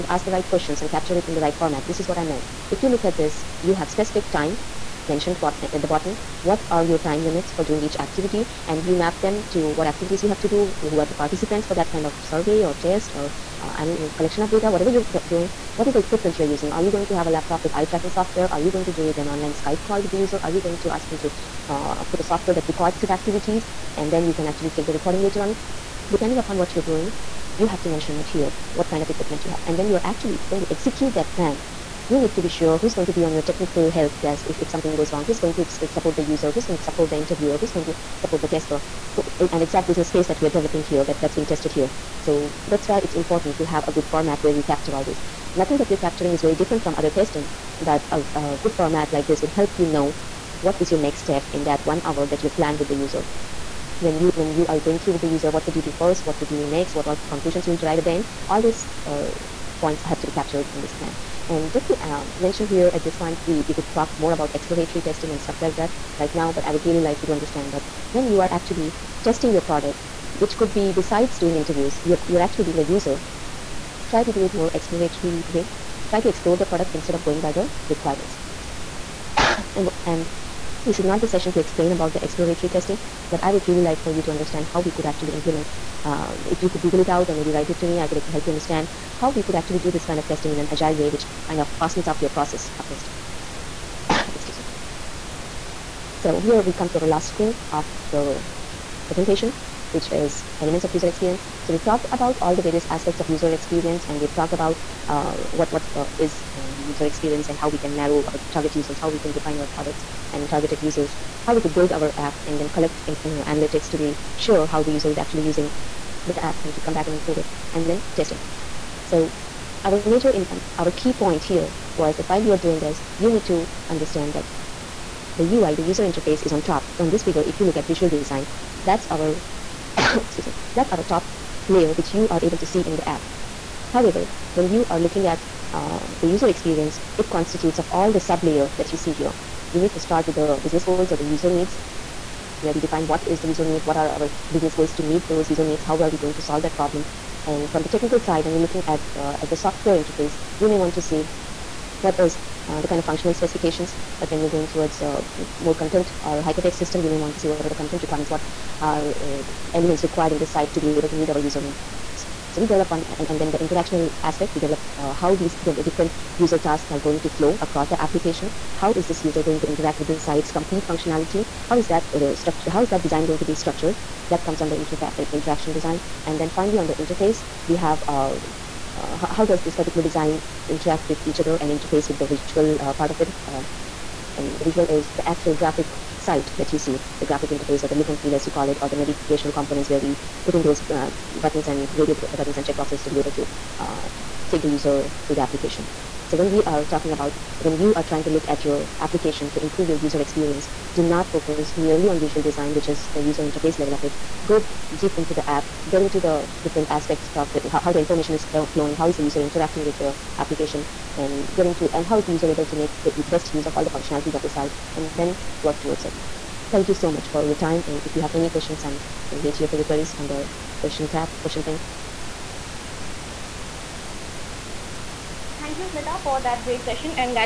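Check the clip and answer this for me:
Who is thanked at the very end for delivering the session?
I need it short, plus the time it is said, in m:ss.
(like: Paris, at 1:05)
Smita, at 3:45.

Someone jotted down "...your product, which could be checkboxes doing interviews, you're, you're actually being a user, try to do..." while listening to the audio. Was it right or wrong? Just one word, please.
wrong.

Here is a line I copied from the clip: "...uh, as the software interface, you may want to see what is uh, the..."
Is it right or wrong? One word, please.
right.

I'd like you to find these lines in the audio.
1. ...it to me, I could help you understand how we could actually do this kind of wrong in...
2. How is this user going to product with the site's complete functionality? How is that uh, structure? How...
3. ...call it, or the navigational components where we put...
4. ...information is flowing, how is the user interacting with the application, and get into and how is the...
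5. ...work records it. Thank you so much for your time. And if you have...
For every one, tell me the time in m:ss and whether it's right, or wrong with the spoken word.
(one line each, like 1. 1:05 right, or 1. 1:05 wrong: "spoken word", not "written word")
1. 1:27 wrong: "testing", not "wrong"
2. 2:48 wrong: "interact", not "product"
3. 3:08 right
4. 3:27 right
5. 3:35 wrong: "towards", not "records".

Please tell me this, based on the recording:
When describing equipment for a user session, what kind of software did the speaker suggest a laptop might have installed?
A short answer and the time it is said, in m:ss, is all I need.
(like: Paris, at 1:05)
eye tracking software, at 0:17.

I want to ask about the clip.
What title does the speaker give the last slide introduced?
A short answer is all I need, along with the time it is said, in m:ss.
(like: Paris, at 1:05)
elements of user experience, at 1:40.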